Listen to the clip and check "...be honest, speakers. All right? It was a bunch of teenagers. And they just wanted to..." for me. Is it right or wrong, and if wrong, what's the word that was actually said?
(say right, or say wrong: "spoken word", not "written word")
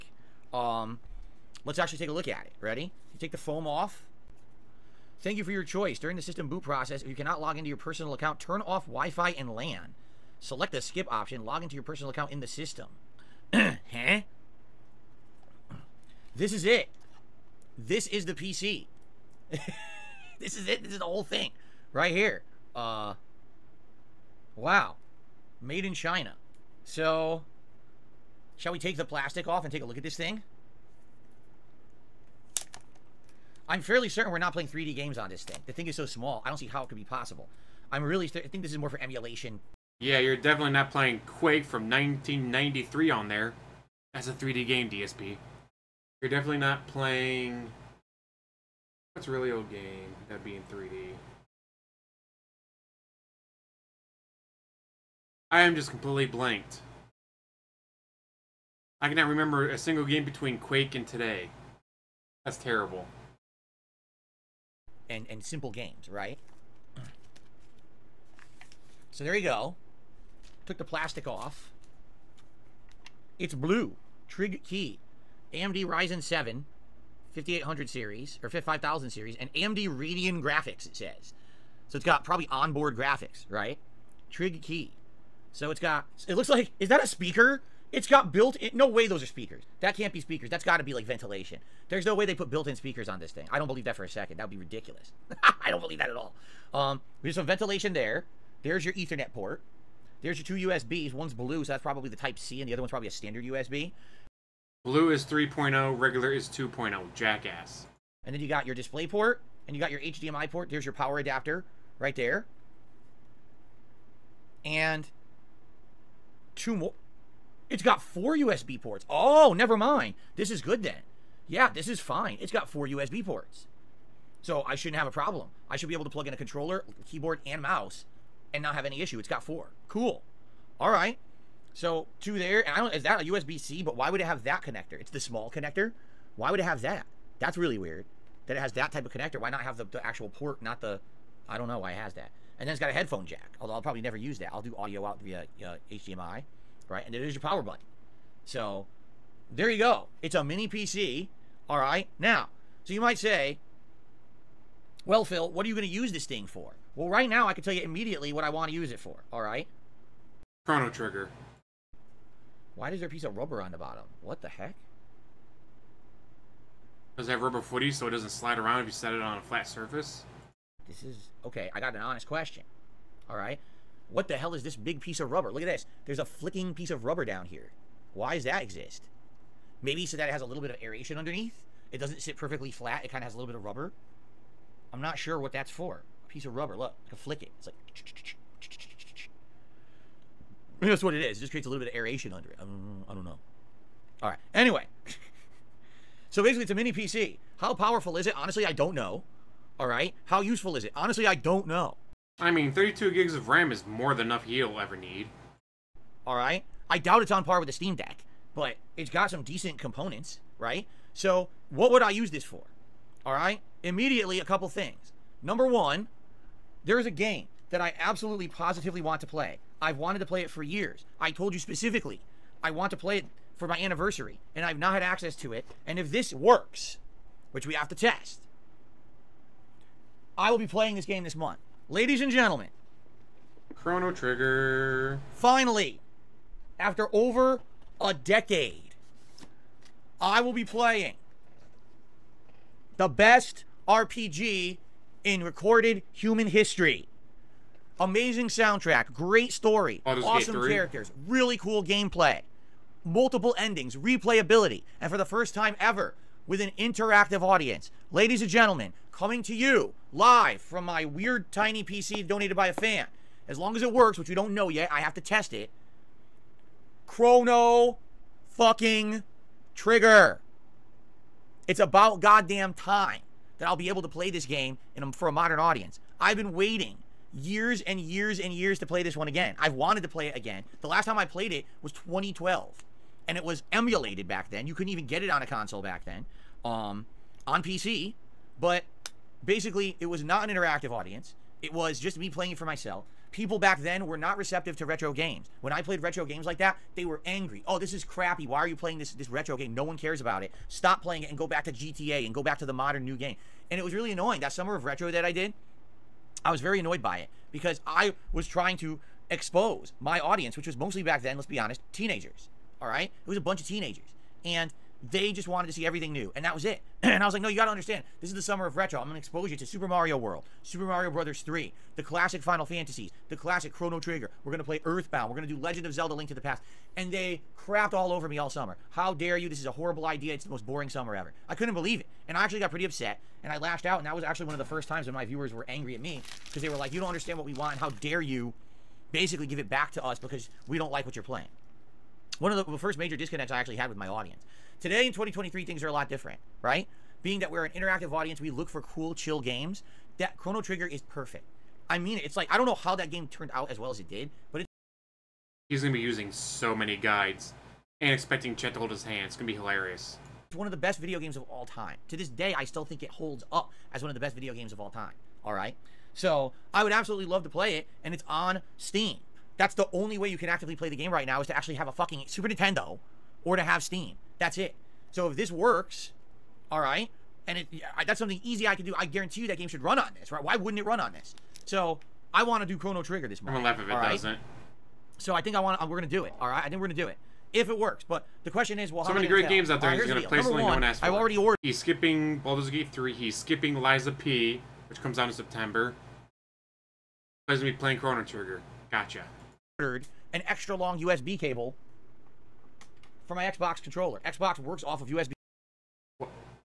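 wrong: "teenagers", not "speakers".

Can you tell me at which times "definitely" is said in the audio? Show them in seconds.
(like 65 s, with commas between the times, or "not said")
40 s, 46 s.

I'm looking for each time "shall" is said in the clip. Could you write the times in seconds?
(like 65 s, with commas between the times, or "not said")
28 s.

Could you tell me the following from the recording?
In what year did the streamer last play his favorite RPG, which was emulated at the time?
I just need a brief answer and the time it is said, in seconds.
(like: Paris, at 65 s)
2012, at 281 s.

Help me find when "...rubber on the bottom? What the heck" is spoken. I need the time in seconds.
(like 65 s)
163 s.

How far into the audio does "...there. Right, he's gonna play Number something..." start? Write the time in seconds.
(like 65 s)
389 s.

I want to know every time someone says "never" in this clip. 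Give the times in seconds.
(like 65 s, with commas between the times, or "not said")
119 s, 144 s.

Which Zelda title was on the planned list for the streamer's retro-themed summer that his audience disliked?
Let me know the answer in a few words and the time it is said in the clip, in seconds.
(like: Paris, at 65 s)
Link to the Past, at 326 s.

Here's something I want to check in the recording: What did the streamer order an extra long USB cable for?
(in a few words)
Xbox controller.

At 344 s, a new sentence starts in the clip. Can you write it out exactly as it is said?
Today in 2023, things are a lot different, right?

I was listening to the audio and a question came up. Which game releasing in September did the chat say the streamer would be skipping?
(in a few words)
Lies of P.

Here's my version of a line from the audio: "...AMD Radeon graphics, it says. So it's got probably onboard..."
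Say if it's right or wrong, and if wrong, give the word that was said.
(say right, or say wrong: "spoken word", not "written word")
right.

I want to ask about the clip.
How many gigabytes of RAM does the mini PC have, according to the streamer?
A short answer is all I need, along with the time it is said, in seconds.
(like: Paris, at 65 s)
32, at 202 s.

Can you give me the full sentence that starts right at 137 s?
That's really weird that it has that type of connector.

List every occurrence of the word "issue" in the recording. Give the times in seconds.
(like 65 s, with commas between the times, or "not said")
129 s.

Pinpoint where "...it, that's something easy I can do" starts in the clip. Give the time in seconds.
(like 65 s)
377 s.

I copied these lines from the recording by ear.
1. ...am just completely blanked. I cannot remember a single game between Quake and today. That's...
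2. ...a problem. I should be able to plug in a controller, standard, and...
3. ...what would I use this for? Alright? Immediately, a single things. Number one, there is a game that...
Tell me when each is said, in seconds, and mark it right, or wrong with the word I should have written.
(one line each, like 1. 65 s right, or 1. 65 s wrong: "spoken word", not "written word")
1. 55 s right
2. 125 s wrong: "keyboard", not "standard"
3. 211 s wrong: "couple", not "single".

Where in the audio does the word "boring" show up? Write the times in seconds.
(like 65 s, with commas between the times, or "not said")
330 s.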